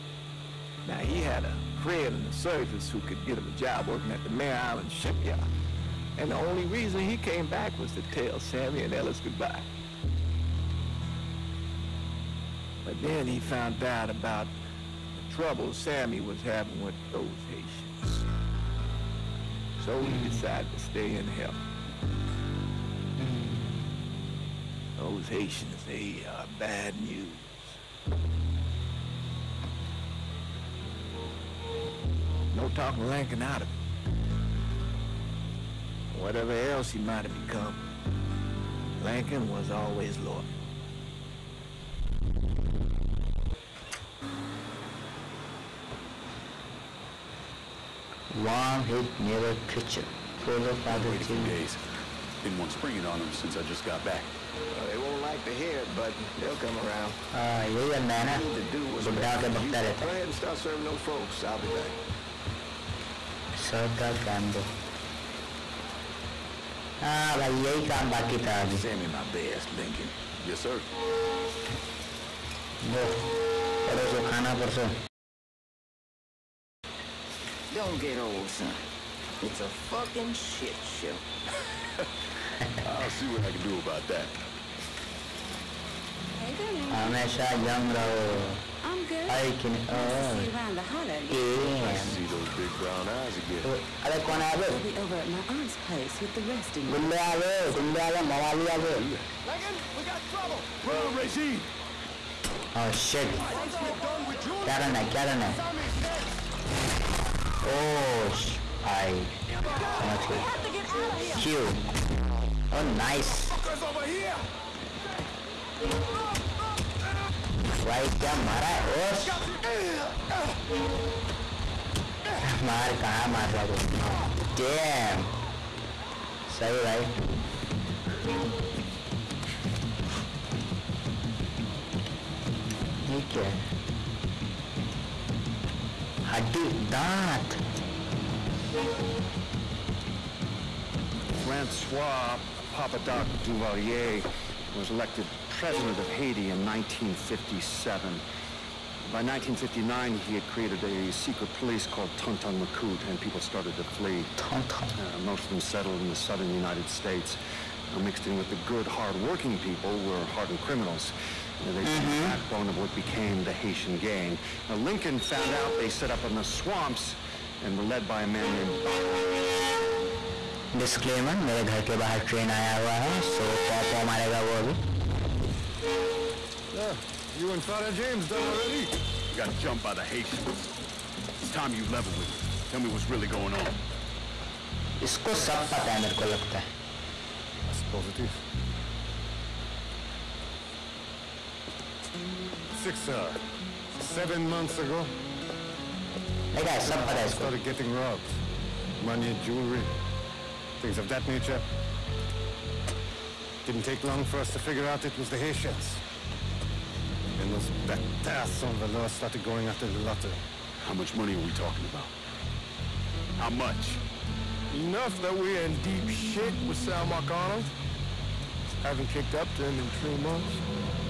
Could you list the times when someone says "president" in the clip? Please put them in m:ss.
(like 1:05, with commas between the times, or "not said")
2:25.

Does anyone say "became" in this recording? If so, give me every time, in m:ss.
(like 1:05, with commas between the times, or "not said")
2:42.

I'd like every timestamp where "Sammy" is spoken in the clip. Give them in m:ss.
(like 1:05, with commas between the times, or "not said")
0:08, 0:15.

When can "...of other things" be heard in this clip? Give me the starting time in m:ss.
0:50.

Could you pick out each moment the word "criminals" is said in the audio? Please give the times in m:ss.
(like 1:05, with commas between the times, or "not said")
2:40.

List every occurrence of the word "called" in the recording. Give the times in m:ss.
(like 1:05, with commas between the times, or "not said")
2:31.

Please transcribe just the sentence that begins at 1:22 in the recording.
I'll see what I can do about that.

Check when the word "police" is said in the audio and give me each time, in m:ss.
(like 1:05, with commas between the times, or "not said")
2:31.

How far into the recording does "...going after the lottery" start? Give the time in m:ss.
3:29.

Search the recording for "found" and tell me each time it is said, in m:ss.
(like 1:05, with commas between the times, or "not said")
0:13, 2:45.